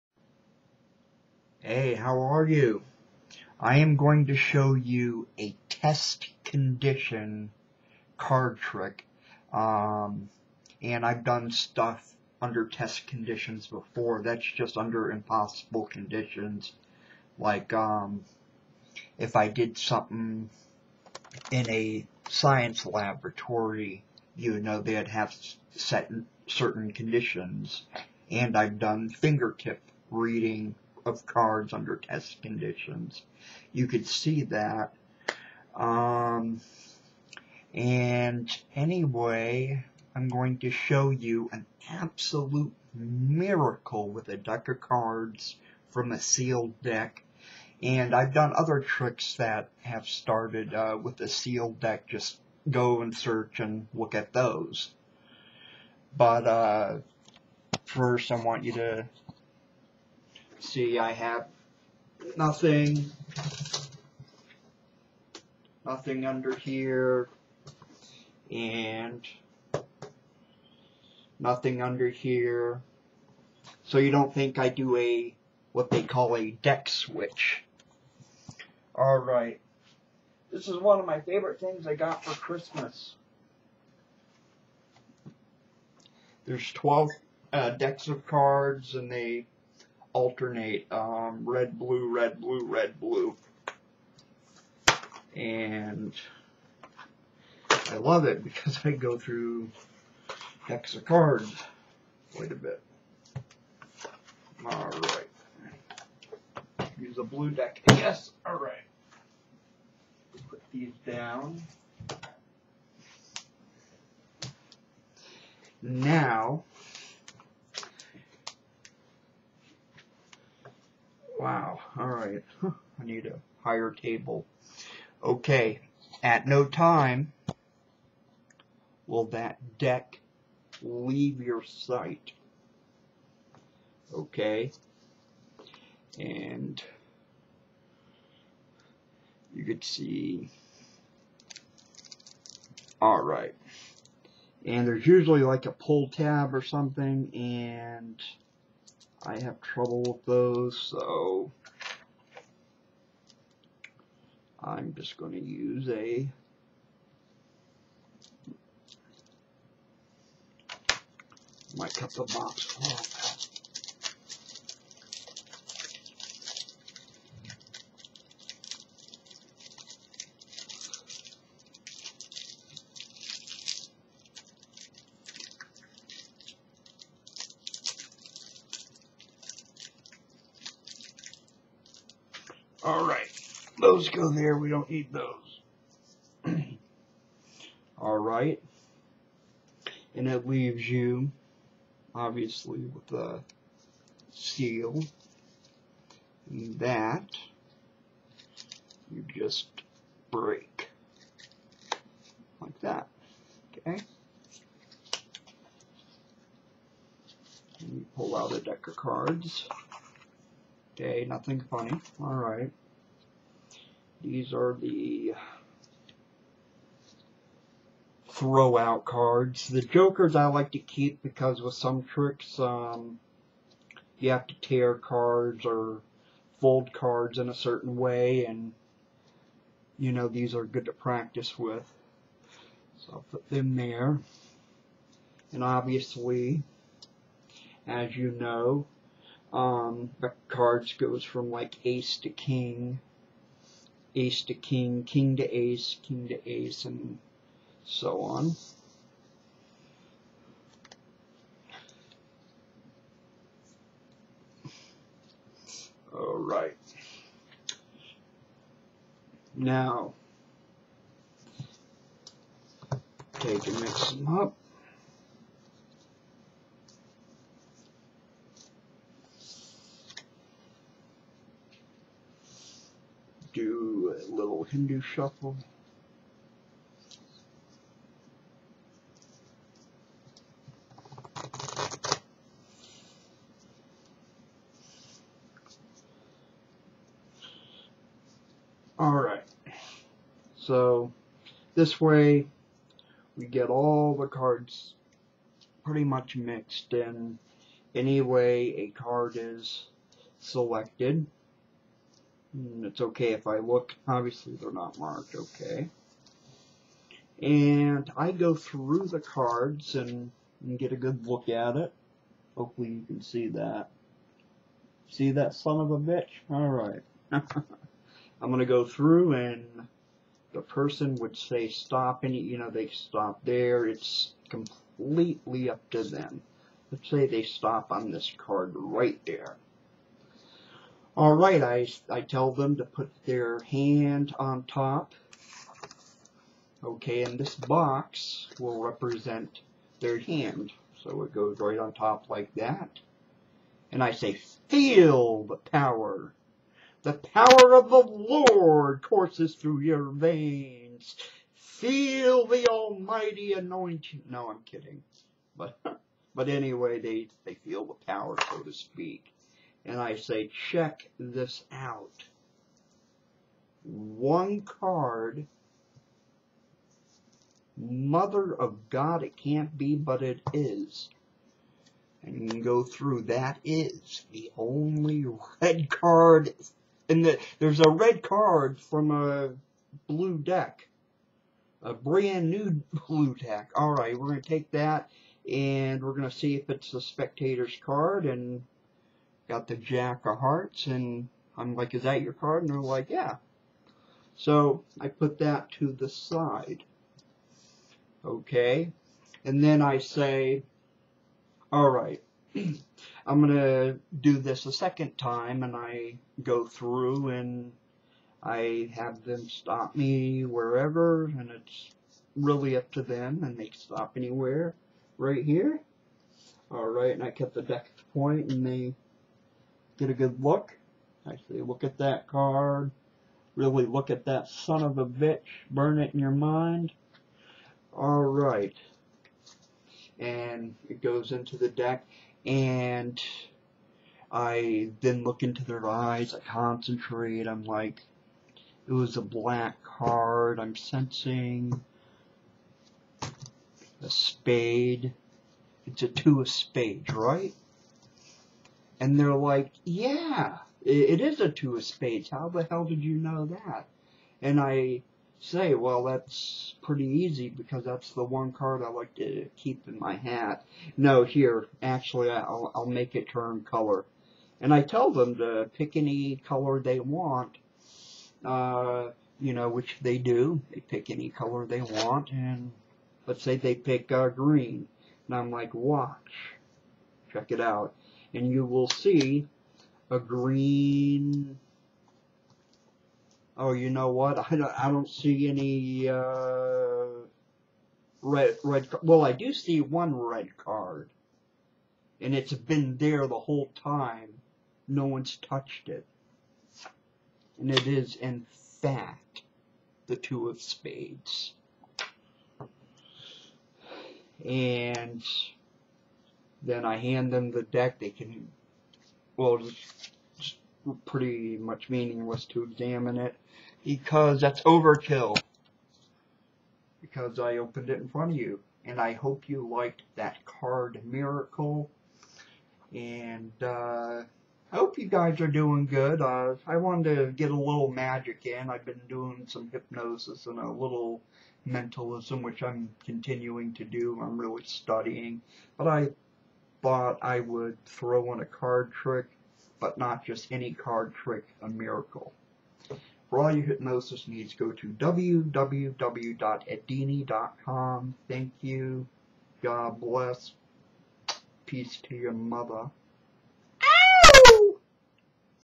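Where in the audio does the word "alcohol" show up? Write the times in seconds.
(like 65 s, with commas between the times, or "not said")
not said.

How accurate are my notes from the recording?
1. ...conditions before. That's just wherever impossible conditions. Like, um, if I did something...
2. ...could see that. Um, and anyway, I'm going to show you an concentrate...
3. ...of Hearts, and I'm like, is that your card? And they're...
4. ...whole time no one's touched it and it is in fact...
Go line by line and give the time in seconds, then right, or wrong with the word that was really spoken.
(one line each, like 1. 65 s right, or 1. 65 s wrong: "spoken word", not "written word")
1. 13 s wrong: "under", not "wherever"
2. 33 s wrong: "absolute", not "concentrate"
3. 390 s right
4. 493 s right.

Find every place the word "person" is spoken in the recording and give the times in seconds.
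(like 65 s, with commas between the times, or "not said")
320 s.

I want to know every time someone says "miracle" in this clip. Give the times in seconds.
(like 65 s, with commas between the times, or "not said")
42 s, 521 s, 541 s.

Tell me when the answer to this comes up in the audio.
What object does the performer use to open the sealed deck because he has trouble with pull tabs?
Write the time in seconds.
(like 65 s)
161 s.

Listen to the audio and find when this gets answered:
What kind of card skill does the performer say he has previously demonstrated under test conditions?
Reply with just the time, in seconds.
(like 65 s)
29 s.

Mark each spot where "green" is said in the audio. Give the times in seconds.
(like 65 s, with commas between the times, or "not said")
474 s, 480 s.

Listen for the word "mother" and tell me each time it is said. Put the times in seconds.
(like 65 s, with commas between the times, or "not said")
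367 s, 552 s.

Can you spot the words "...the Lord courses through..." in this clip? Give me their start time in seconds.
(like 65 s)
347 s.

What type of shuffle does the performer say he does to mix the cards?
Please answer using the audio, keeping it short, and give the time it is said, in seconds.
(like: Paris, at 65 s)
Hindu shuffle, at 274 s.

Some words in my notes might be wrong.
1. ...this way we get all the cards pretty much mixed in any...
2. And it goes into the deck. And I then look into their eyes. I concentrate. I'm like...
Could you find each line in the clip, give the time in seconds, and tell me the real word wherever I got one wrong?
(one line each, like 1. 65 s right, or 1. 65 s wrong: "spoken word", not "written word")
1. 291 s right
2. 430 s right.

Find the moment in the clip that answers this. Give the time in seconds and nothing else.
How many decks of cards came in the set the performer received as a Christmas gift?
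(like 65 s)
86 s.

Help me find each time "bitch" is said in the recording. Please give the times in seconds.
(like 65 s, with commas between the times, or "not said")
315 s, 425 s.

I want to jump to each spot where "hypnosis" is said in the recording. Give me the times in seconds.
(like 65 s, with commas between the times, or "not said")
529 s, 543 s.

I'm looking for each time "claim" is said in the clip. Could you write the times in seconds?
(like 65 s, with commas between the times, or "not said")
not said.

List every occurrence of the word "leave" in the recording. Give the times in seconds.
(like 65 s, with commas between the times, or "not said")
130 s, 190 s.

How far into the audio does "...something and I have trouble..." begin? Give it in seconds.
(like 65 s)
146 s.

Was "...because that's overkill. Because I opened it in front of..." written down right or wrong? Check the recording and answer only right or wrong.
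right.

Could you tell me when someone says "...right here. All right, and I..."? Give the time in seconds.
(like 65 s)
415 s.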